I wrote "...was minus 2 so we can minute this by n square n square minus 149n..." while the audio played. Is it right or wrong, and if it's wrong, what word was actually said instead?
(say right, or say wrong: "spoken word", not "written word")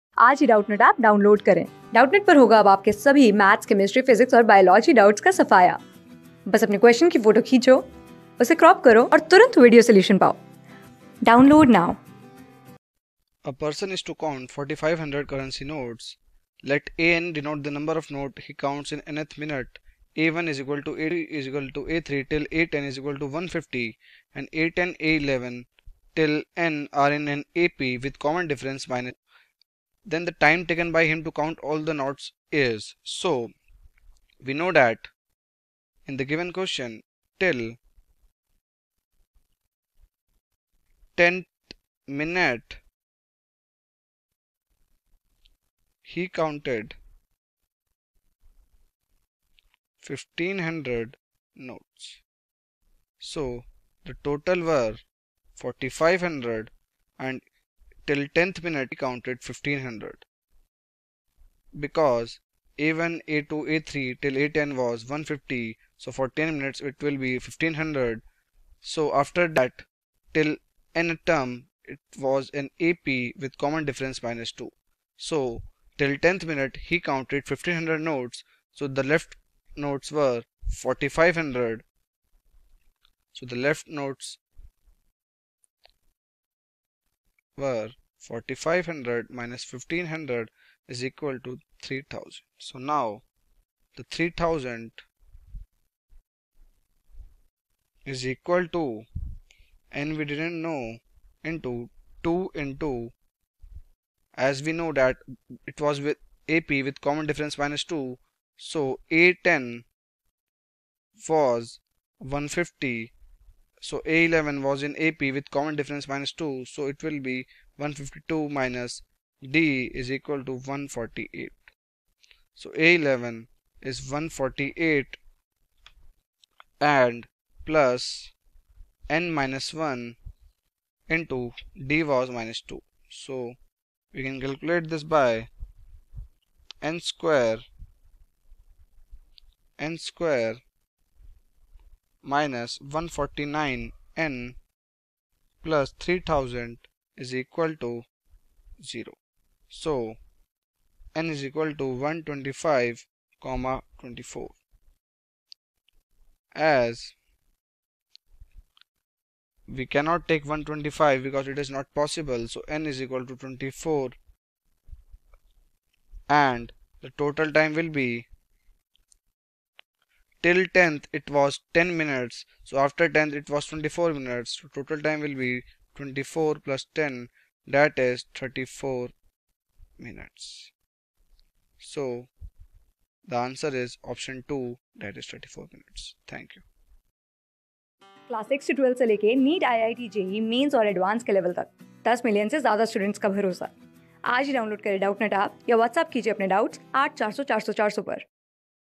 wrong: "calculate", not "minute".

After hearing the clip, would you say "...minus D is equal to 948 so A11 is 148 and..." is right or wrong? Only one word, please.
wrong.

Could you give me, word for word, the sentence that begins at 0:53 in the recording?
So the total were 4500 and Till tenth minute he counted 1500.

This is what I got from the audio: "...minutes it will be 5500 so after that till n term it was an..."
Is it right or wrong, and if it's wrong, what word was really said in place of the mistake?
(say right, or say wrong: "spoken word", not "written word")
wrong: "1500", not "5500".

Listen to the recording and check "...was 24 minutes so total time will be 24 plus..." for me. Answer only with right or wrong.
right.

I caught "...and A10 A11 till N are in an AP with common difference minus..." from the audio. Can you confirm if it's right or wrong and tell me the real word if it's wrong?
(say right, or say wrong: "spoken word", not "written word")
right.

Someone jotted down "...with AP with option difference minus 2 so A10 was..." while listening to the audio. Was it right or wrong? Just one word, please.
wrong.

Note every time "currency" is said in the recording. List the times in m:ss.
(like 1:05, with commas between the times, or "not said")
0:15.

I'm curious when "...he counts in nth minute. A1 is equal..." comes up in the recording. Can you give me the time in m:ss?
0:18.